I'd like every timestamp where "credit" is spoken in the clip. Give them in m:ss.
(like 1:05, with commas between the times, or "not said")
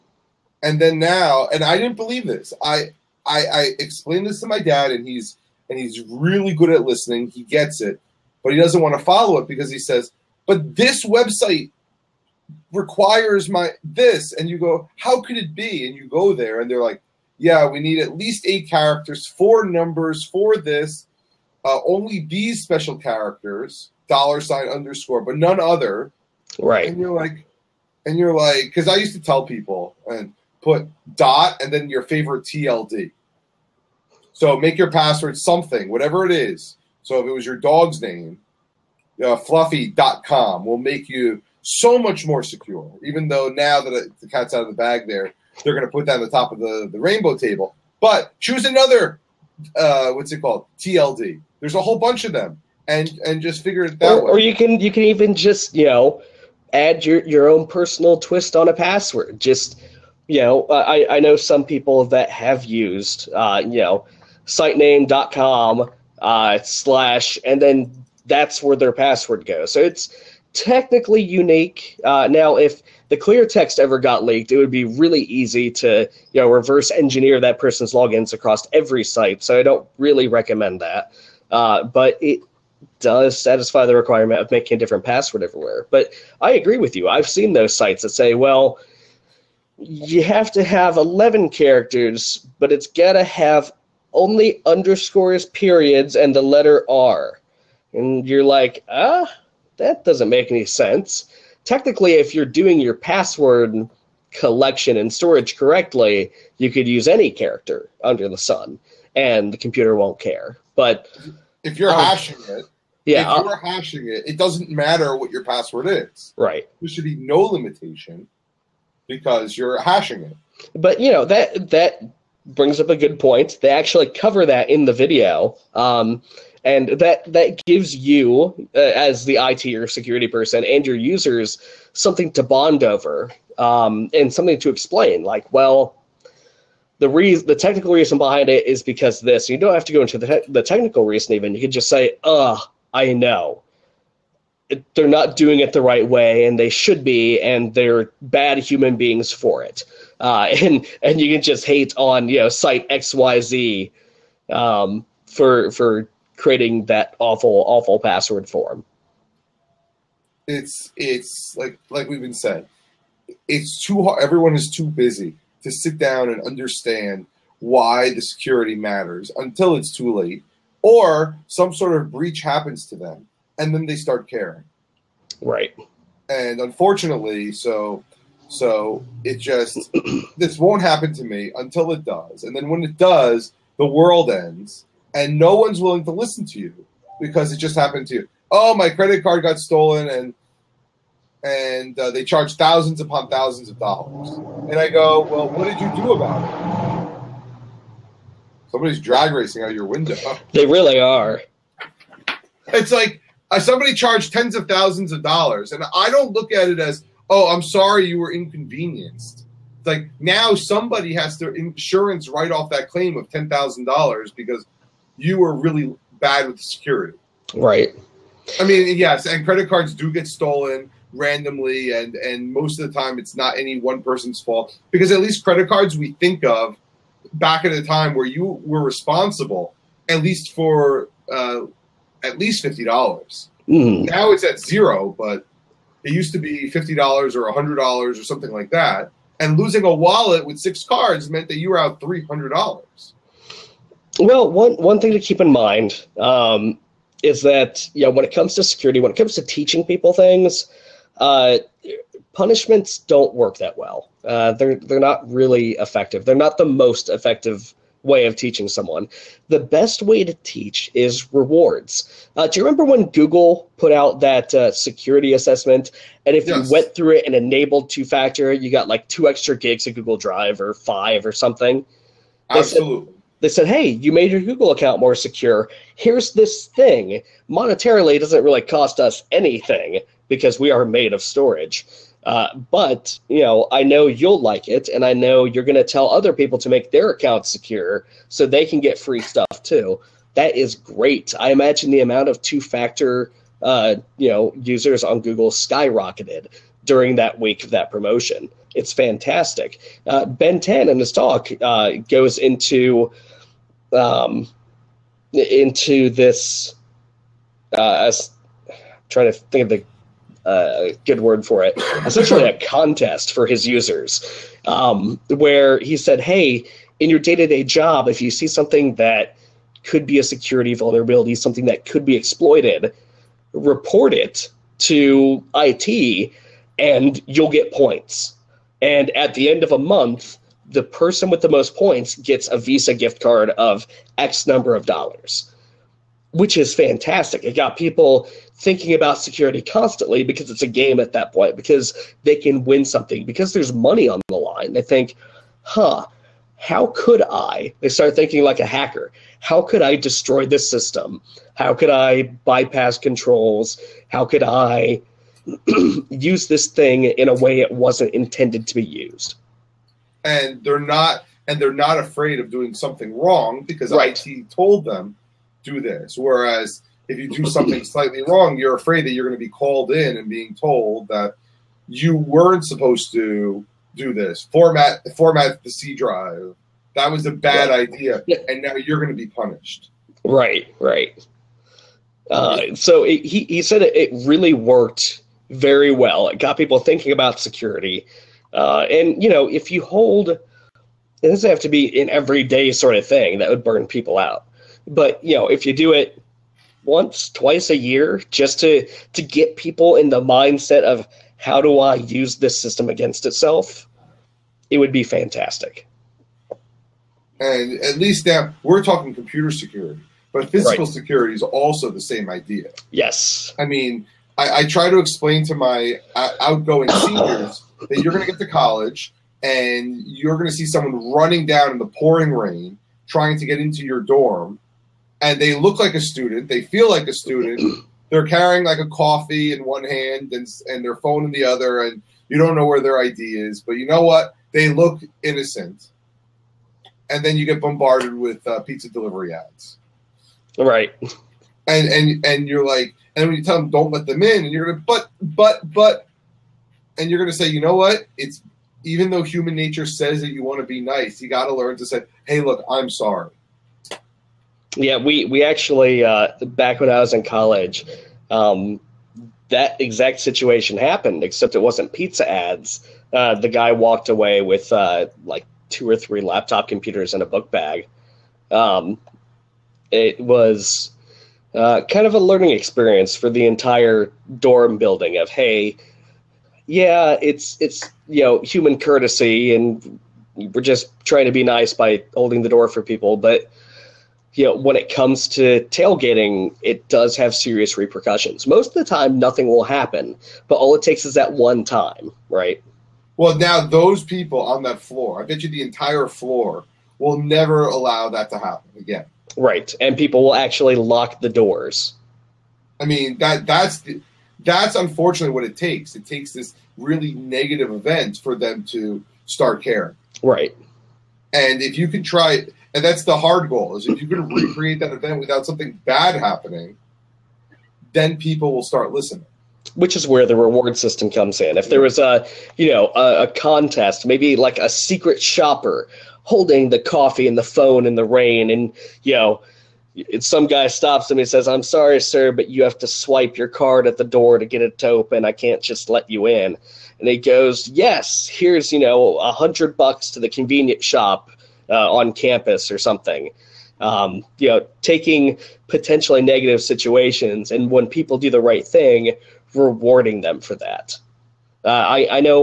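3:08, 3:39, 3:45.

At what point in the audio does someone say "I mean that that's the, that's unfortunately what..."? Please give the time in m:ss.
8:22.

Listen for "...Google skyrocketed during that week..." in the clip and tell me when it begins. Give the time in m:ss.
4:55.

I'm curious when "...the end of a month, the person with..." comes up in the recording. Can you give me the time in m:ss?
5:29.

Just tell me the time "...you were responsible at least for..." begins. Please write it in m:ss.
3:48.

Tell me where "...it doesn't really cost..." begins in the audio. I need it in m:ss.
4:38.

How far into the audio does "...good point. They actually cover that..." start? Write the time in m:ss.
2:02.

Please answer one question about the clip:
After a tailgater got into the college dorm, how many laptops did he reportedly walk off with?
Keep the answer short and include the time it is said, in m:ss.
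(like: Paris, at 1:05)
2 or 3, at 7:45.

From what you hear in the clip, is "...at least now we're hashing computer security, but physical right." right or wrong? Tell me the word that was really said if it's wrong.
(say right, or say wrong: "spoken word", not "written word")
wrong: "talking", not "hashing".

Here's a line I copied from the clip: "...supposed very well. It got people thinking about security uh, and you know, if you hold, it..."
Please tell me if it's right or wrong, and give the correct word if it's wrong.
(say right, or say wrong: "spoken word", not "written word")
wrong: "worked", not "supposed".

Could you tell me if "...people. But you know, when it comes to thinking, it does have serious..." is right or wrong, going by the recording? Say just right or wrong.
wrong.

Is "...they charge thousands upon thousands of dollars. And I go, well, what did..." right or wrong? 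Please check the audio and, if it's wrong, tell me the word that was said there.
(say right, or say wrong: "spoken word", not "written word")
right.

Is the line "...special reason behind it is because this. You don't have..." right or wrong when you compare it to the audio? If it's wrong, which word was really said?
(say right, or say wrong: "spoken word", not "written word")
wrong: "technical", not "special".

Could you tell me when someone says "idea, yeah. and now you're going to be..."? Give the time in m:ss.
6:17.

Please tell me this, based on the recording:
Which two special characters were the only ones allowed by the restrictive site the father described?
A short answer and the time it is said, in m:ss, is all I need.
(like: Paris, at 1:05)
dollar sign, underscore, at 0:24.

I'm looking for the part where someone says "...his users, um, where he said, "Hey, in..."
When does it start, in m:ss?
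5:13.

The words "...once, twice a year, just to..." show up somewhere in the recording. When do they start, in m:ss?
6:36.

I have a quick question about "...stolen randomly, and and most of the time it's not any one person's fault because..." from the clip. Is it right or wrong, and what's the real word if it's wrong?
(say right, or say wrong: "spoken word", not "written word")
right.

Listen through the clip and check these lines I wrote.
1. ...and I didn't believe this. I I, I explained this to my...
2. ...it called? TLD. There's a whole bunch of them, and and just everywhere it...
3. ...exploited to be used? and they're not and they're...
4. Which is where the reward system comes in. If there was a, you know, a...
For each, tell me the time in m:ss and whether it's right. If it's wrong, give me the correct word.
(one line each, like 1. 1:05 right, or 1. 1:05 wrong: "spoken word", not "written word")
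1. 0:01 right
2. 0:50 wrong: "figure", not "everywhere"
3. 5:58 wrong: "intended", not "exploited"
4. 8:39 right.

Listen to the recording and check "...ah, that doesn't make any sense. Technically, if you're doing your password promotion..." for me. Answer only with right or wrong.
wrong.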